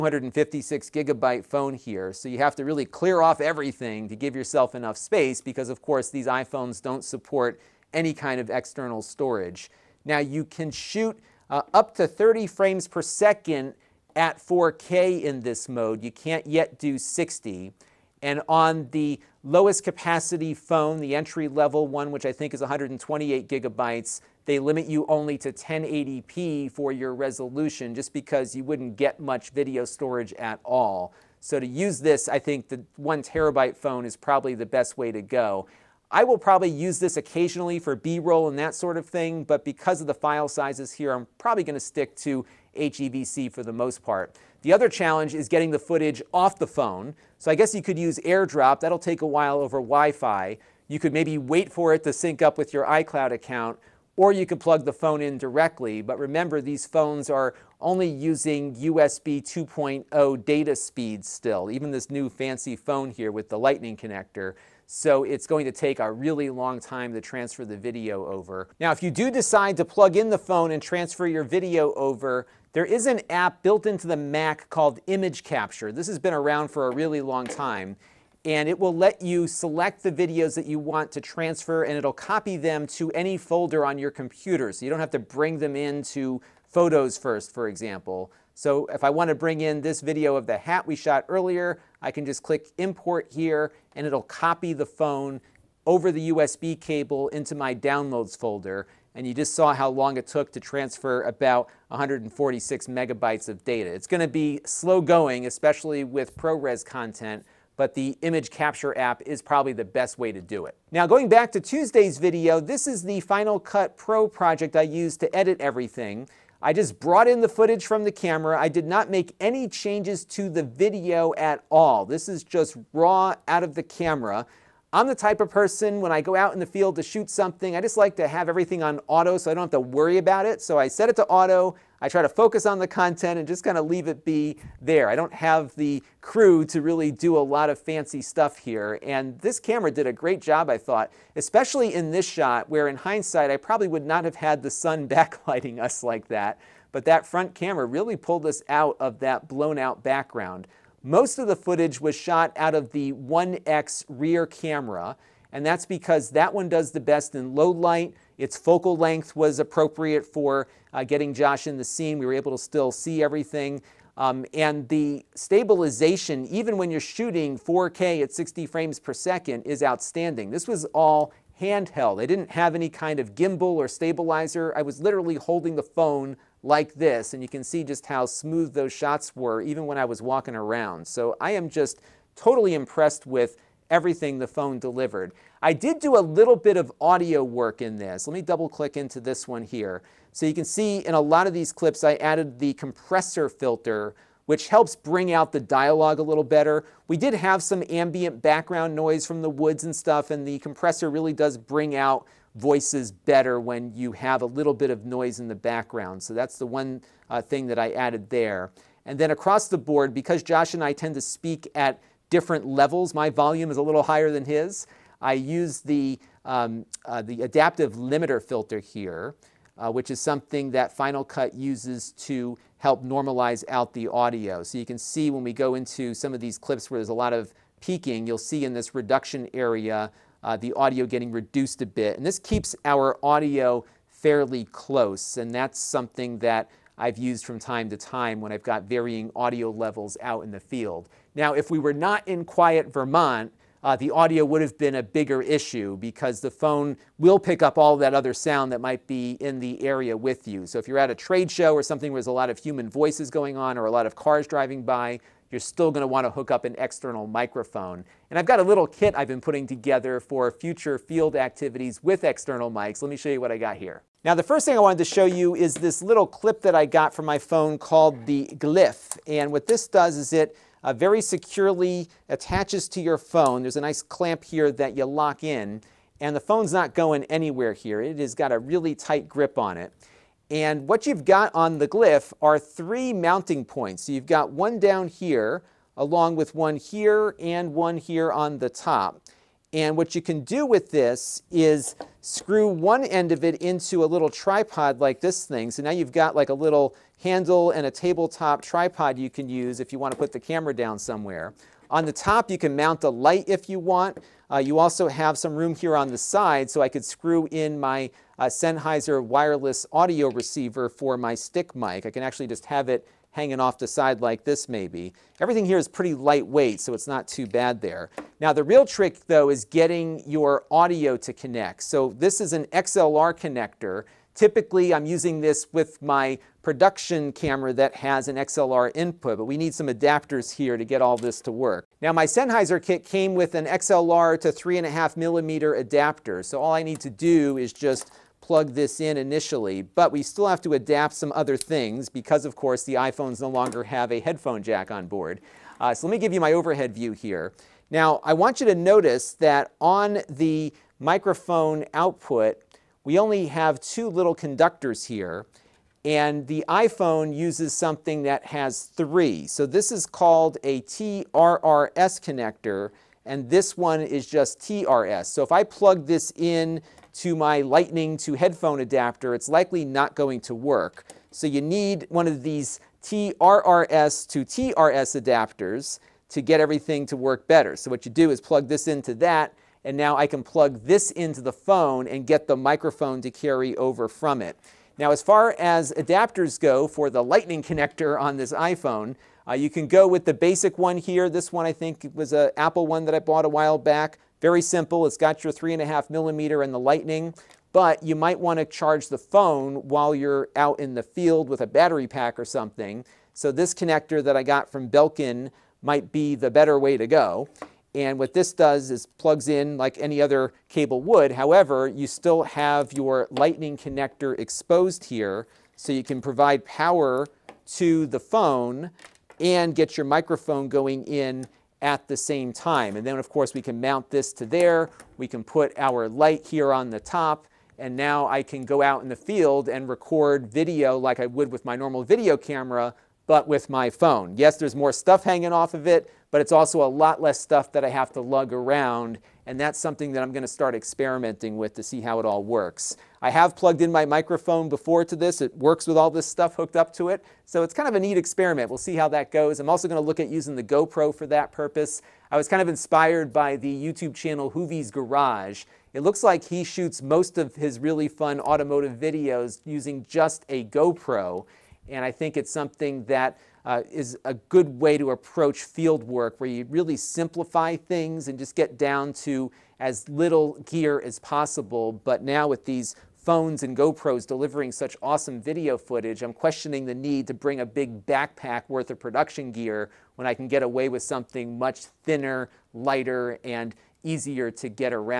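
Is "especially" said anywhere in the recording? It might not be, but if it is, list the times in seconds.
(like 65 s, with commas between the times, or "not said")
105 s, 141 s.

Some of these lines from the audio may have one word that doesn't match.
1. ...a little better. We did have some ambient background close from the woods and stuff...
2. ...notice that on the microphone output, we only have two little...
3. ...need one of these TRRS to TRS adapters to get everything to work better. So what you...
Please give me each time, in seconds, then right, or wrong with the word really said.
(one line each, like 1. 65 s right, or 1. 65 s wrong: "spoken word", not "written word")
1. 196 s wrong: "noise", not "close"
2. 348 s right
3. 371 s right.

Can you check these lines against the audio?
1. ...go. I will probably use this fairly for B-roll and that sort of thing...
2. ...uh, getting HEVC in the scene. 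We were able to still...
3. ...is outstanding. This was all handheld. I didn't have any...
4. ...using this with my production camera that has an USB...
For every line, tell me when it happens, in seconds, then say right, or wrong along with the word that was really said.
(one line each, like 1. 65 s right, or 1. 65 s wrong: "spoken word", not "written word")
1. 35 s wrong: "occasionally", not "fairly"
2. 160 s wrong: "Josh", not "HEVC"
3. 169 s right
4. 325 s wrong: "XLR", not "USB".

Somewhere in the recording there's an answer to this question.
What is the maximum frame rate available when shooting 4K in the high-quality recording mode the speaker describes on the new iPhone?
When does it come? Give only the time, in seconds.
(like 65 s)
12 s.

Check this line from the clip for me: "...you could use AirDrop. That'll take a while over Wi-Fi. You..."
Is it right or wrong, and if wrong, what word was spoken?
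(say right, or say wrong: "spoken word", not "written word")
right.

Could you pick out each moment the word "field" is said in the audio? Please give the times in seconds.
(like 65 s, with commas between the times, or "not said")
126 s, 240 s, 260 s, 401 s, 429 s, 465 s.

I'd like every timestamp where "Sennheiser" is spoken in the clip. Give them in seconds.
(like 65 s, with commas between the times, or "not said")
308 s, 332 s.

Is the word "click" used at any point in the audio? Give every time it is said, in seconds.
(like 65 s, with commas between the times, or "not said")
92 s, 188 s.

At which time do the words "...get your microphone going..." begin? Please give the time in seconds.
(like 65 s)
419 s.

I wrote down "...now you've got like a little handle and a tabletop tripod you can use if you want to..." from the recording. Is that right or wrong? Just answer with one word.
right.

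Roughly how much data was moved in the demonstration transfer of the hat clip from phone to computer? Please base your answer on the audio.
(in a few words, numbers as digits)
146 megabytes.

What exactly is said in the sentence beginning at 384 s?
Now, as far as adapters go for the lightning connector on this iPhone, uh, you can go with the basic one here.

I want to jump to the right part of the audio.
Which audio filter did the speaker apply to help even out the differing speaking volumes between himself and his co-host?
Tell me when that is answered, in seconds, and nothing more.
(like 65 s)
217 s.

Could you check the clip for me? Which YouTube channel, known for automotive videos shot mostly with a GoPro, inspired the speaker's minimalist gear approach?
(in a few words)
Hoovie's Garage.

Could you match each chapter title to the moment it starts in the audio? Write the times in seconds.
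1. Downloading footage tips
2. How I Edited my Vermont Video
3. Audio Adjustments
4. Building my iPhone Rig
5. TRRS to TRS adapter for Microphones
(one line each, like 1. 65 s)
1. 42 s
2. 109 s
3. 183 s
4. 262 s
5. 329 s.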